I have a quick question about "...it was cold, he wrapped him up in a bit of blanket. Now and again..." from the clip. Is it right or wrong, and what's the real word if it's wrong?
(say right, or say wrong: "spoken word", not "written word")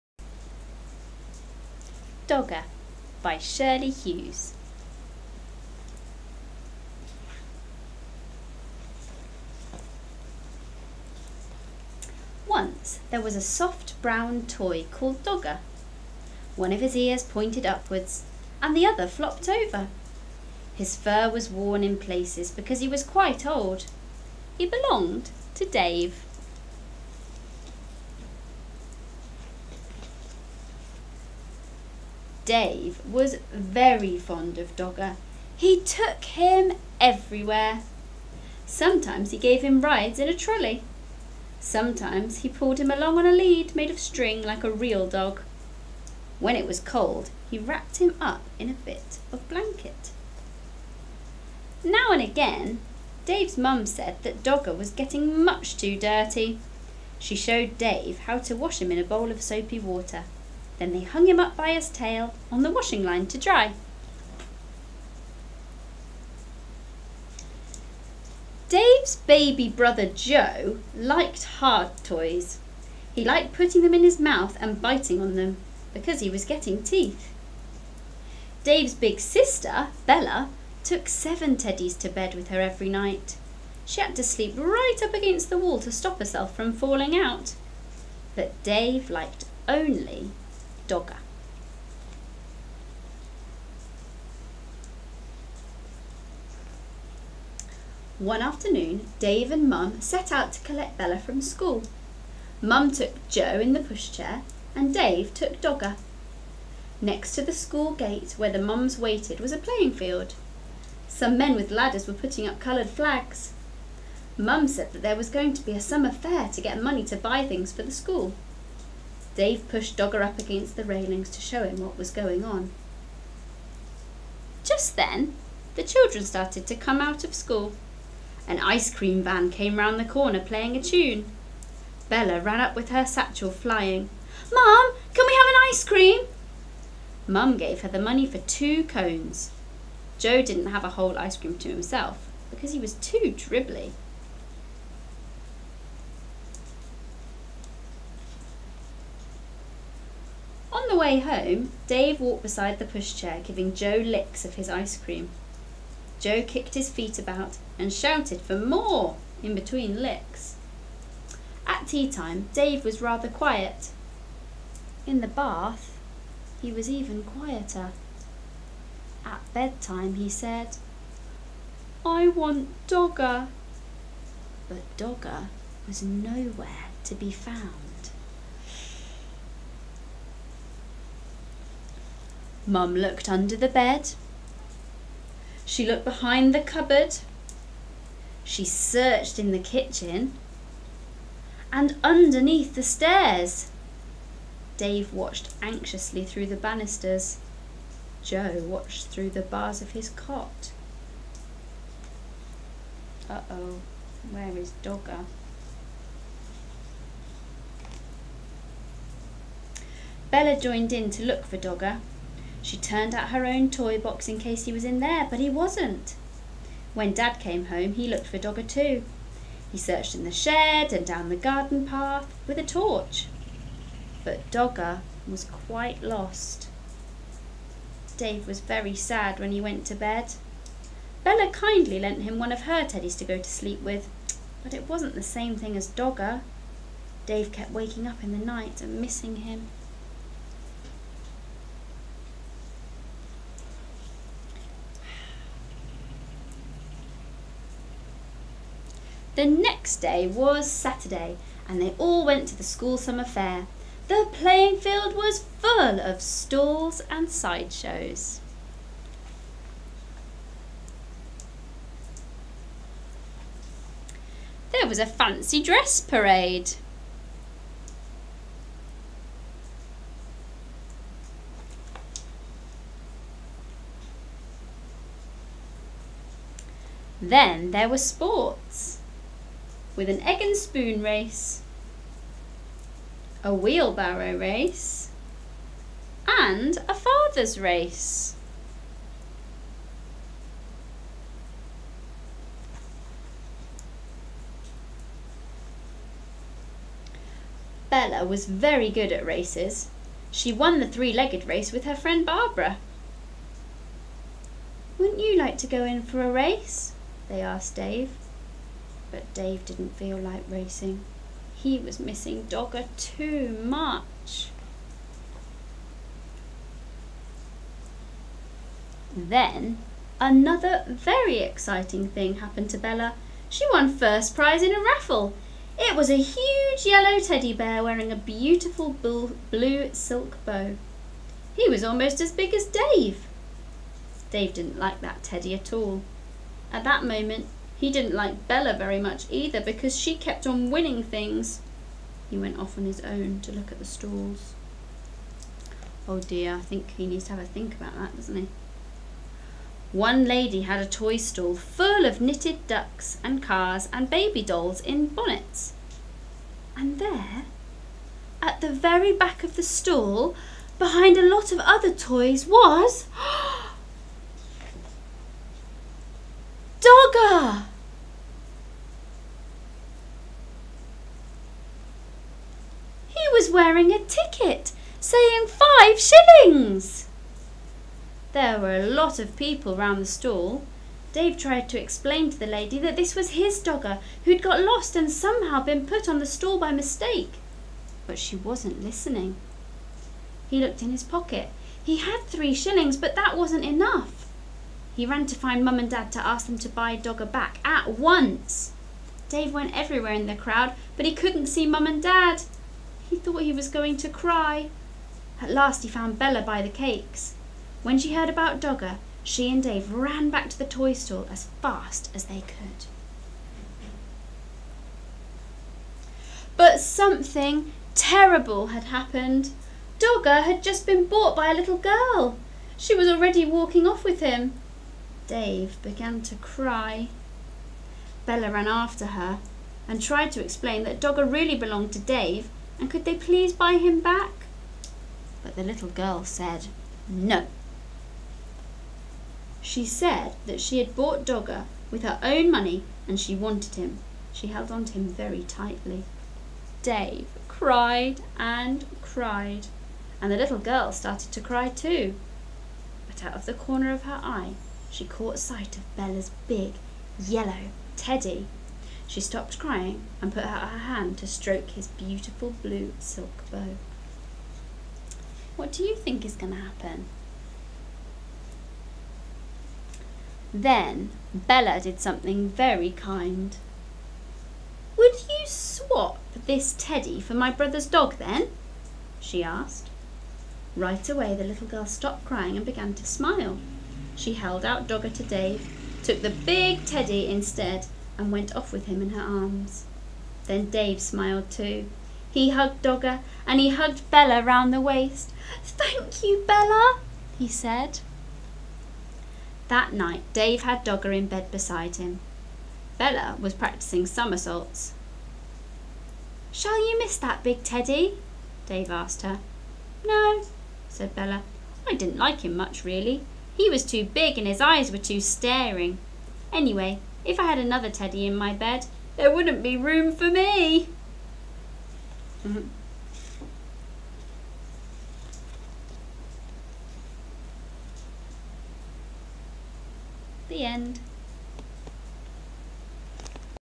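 right.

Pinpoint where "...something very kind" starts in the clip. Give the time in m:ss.
7:51.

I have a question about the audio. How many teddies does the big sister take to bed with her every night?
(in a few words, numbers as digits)
7.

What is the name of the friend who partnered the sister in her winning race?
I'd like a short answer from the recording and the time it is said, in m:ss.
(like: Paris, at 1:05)
Barbara, at 5:02.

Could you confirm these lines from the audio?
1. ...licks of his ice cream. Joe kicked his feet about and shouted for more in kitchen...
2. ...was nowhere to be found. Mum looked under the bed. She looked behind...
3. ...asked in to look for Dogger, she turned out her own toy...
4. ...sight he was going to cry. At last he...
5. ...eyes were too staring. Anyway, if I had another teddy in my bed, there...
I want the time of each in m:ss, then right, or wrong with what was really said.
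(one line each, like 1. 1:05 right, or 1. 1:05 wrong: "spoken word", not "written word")
1. 2:34 wrong: "between", not "kitchen"
2. 2:55 right
3. 3:30 wrong: "joined", not "asked"
4. 6:43 wrong: "thought", not "sight"
5. 8:34 right.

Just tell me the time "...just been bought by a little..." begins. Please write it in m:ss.
7:00.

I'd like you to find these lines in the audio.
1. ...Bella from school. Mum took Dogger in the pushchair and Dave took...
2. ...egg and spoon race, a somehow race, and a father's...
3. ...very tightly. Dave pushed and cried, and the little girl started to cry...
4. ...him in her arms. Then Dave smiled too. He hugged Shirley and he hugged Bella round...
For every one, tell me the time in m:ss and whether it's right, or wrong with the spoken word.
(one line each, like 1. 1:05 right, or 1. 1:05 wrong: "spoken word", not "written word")
1. 1:40 wrong: "Joe", not "Dogger"
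2. 4:40 wrong: "wheelbarrow", not "somehow"
3. 7:25 wrong: "cried", not "pushed"
4. 8:08 wrong: "Dogger", not "Shirley".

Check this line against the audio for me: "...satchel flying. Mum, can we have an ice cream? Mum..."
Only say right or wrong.
right.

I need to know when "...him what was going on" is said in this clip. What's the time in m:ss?
2:01.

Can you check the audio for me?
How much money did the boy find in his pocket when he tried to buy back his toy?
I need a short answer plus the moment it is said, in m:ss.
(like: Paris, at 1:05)
3 shillings, at 6:32.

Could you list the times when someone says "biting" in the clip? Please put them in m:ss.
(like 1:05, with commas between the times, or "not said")
1:14.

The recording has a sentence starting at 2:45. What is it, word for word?
In the bath, he was even quieter.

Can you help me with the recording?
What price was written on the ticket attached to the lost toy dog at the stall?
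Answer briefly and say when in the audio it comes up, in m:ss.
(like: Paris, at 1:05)
5 shillings, at 6:15.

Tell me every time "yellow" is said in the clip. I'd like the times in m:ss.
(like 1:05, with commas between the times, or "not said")
5:26, 7:37.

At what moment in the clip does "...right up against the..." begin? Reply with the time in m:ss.
1:24.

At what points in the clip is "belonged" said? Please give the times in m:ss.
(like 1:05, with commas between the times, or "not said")
0:24, 7:11.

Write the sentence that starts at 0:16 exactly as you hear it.
One of his ears pointed upwards and the other flopped over.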